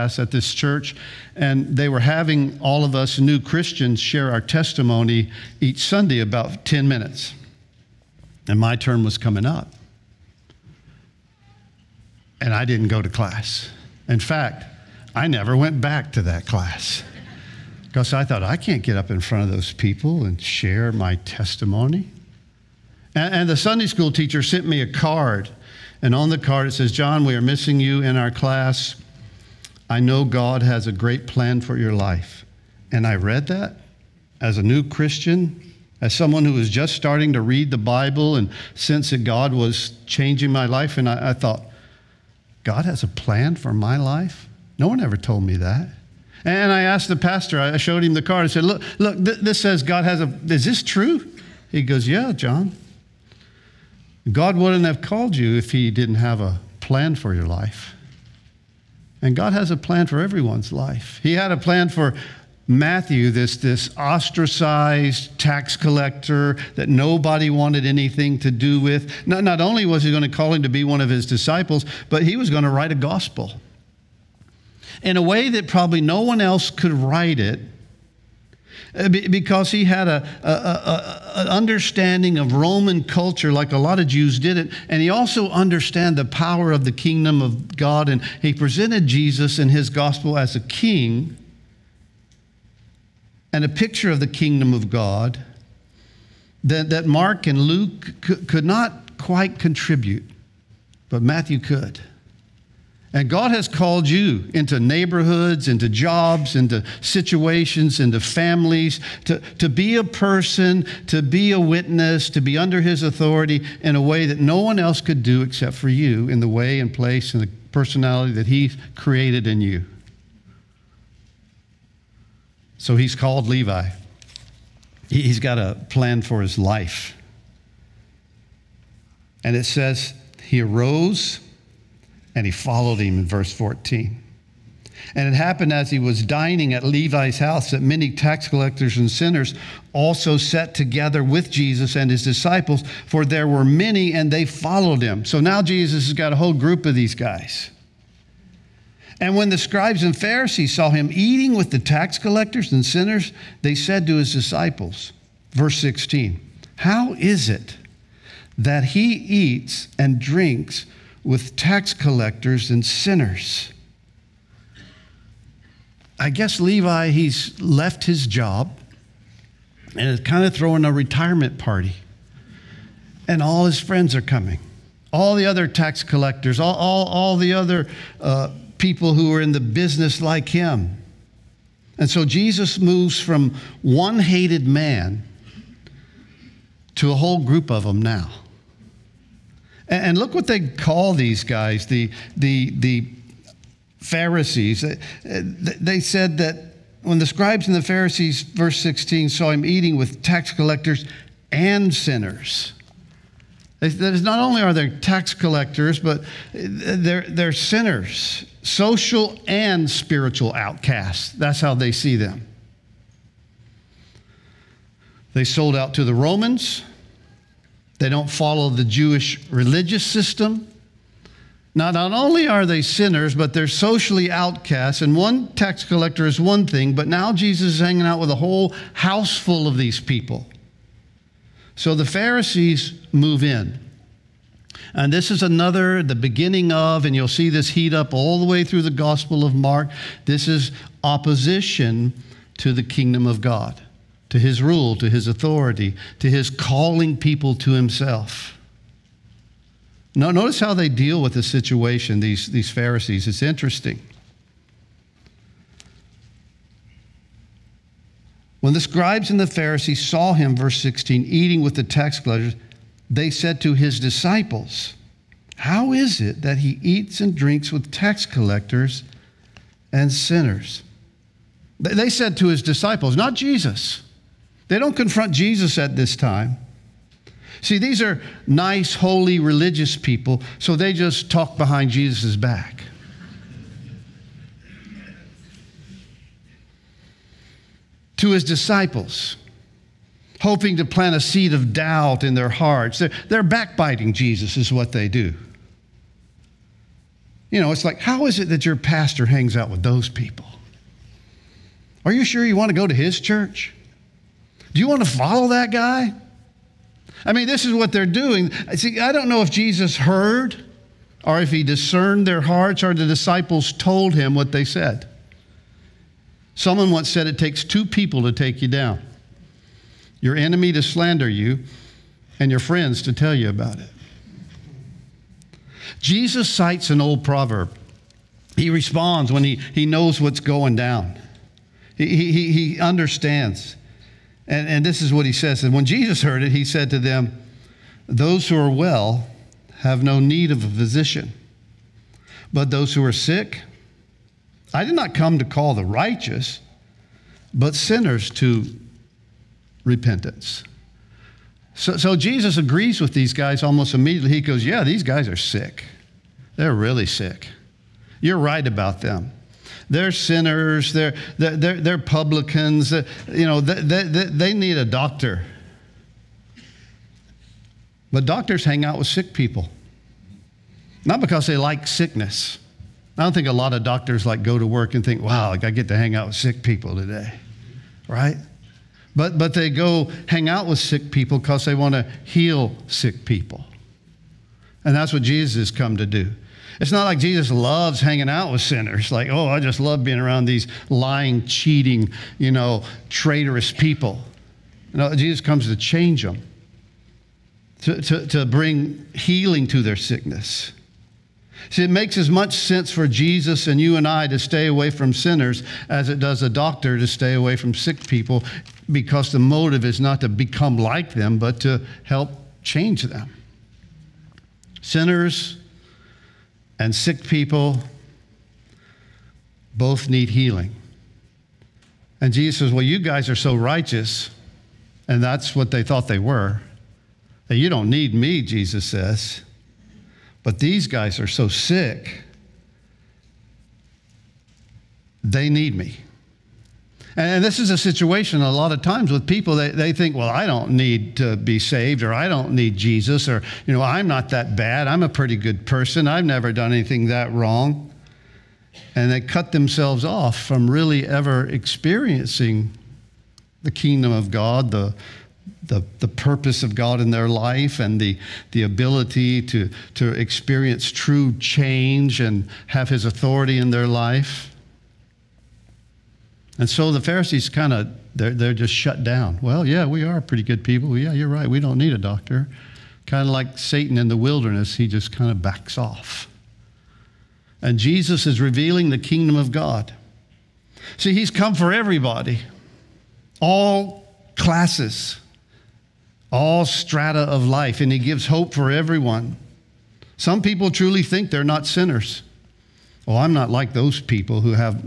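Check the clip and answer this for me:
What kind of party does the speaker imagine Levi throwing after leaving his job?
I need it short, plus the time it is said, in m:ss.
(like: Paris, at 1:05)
A retirement party, at 2:50.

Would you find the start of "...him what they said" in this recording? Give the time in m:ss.
5:14.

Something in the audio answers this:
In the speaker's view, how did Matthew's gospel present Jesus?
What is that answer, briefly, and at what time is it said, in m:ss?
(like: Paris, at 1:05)
As a king, at 1:30.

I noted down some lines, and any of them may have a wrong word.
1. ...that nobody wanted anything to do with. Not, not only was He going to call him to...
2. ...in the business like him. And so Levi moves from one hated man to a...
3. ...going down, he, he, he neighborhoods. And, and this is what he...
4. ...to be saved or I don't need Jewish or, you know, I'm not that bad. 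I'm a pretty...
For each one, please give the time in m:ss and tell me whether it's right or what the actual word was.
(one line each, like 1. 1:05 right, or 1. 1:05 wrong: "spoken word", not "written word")
1. 1:06 right
2. 2:59 wrong: "Jesus", not "Levi"
3. 5:30 wrong: "understands", not "neighborhoods"
4. 7:21 wrong: "Jesus", not "Jewish".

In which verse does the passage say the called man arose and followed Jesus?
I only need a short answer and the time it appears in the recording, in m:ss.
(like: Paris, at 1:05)
Verse 14, at 2:13.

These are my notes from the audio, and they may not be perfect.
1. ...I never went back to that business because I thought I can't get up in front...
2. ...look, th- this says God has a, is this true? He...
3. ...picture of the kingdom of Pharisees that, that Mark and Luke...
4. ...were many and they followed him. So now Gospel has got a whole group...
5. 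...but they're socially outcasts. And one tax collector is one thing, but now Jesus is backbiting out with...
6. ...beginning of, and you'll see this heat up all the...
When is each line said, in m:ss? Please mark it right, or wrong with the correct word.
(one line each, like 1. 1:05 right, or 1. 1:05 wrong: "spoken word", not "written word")
1. 0:15 wrong: "class", not "business"
2. 0:48 right
3. 1:33 wrong: "God", not "Pharisees"
4. 2:23 wrong: "Jesus", not "Gospel"
5. 3:43 wrong: "hanging", not "backbiting"
6. 3:56 right.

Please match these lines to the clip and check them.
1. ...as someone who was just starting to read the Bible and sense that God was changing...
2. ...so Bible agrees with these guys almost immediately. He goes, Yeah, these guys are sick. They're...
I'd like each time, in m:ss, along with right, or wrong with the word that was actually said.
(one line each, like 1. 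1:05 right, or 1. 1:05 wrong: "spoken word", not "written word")
1. 0:36 right
2. 5:51 wrong: "Jesus", not "Bible".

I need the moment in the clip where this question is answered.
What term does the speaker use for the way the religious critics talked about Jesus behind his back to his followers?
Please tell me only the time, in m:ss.
4:53.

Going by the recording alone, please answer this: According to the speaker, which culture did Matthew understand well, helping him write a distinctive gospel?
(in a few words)
Roman culture.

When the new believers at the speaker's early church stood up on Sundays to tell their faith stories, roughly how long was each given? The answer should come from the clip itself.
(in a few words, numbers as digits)
10 minutes.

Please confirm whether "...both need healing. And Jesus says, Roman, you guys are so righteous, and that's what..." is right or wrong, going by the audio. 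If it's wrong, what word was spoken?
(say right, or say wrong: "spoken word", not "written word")
wrong: "Well", not "Roman".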